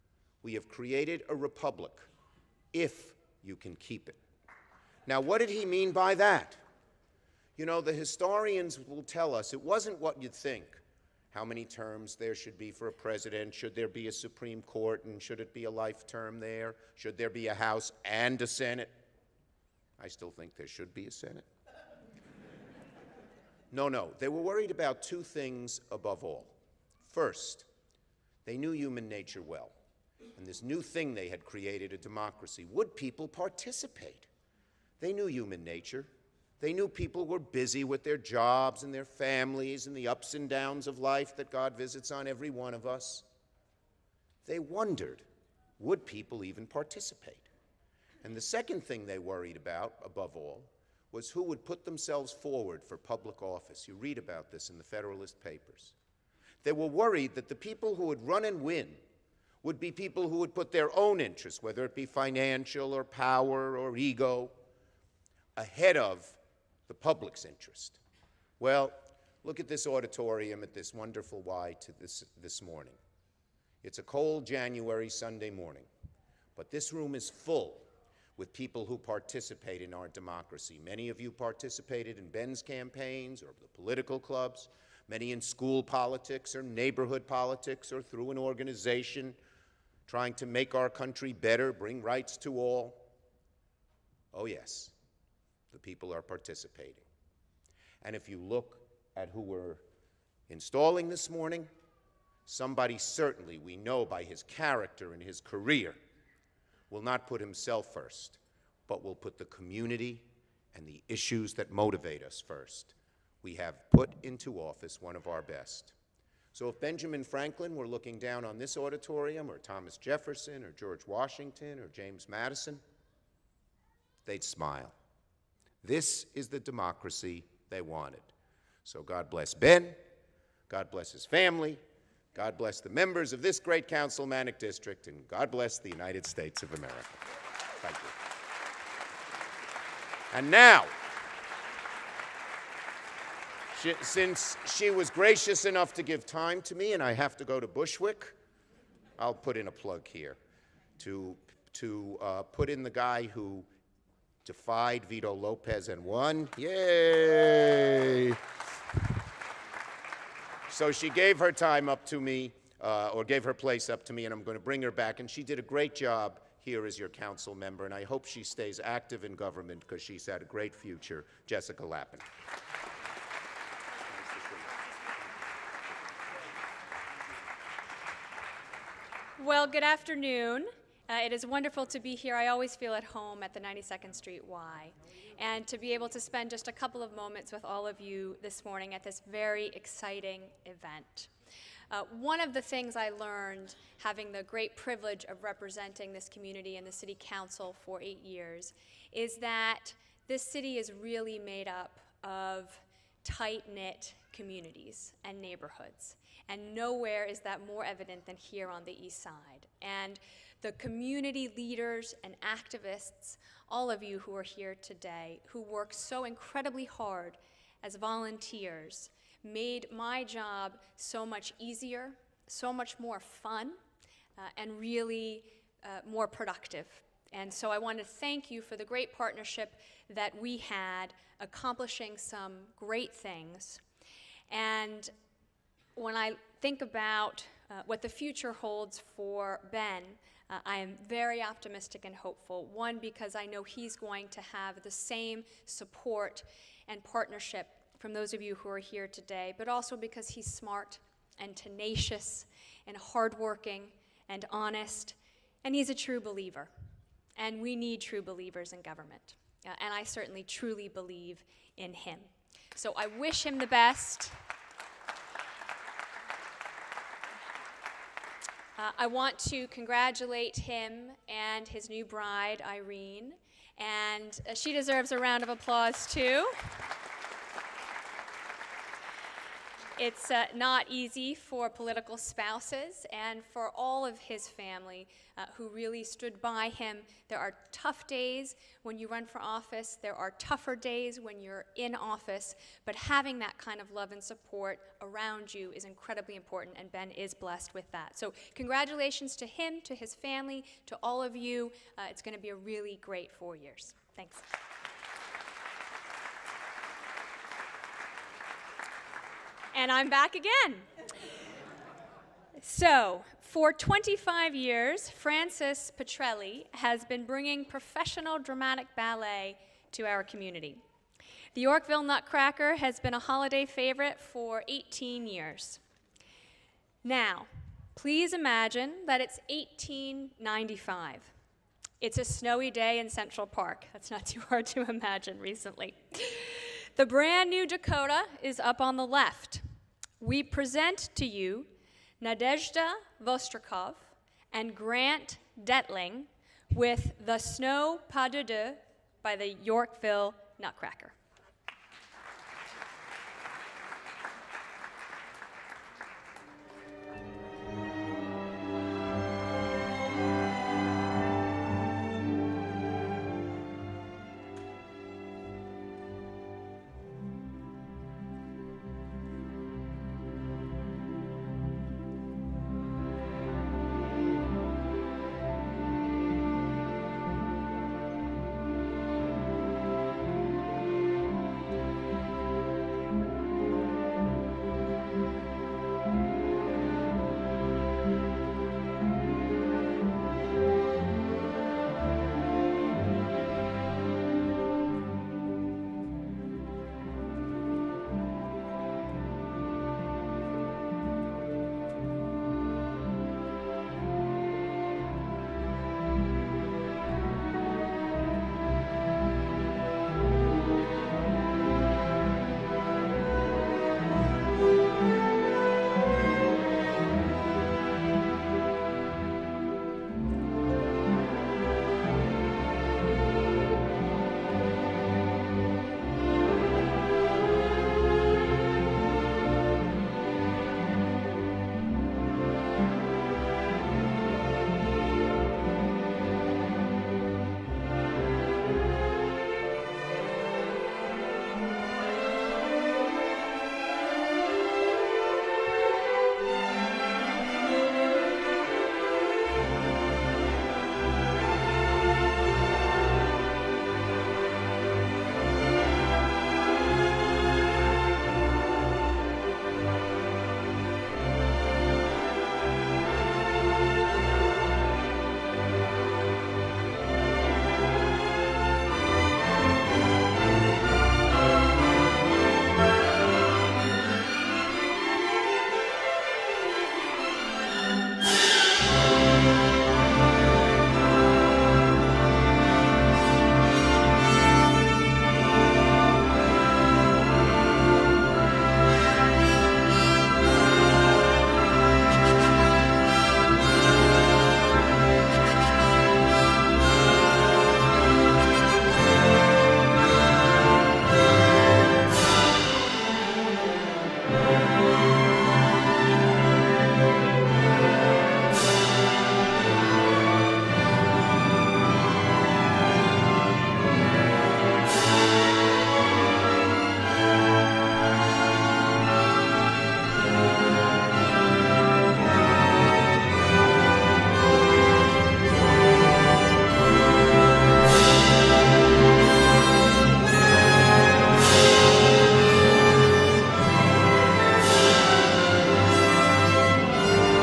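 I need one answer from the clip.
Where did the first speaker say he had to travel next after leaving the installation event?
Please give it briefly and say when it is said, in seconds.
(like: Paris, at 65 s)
Bushwick, at 147 s.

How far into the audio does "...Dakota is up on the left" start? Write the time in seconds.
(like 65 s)
337 s.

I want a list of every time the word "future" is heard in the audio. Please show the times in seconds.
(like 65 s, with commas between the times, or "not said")
170 s, 238 s.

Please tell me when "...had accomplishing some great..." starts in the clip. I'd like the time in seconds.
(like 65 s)
230 s.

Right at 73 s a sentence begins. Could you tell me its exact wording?
It's a cold January Sunday morning, but this room is full with people who participate in our democracy.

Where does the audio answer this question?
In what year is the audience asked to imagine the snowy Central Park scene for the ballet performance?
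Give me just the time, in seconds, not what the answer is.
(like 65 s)
329 s.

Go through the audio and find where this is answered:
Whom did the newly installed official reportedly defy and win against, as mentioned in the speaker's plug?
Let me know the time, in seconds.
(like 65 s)
155 s.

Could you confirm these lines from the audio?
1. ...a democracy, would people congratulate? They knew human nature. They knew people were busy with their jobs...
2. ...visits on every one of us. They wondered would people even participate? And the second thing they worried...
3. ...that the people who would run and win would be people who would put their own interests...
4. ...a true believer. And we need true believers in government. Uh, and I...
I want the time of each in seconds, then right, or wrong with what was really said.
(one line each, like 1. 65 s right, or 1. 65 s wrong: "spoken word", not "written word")
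1. 31 s wrong: "participate", not "congratulate"
2. 41 s right
3. 57 s right
4. 255 s right.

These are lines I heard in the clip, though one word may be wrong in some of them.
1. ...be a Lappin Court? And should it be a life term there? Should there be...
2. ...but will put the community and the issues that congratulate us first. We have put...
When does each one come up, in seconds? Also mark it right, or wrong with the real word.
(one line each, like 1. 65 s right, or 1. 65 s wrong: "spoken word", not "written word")
1. 13 s wrong: "Supreme", not "Lappin"
2. 108 s wrong: "motivate", not "congratulate".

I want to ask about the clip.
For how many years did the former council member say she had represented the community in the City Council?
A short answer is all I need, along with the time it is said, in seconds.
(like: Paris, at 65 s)
8, at 198 s.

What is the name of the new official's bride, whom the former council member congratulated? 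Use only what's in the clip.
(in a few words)
Irene.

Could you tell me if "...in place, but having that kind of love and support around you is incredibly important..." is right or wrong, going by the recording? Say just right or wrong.
wrong.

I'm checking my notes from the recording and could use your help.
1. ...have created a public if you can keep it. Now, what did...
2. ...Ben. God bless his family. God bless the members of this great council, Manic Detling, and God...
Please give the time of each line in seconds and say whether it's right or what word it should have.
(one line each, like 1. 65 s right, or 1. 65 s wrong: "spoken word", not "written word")
1. 0 s wrong: "republic", not "public"
2. 129 s wrong: "District", not "Detling".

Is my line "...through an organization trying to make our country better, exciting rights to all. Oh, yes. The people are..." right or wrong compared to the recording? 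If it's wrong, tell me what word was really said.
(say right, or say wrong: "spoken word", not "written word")
wrong: "bring", not "exciting".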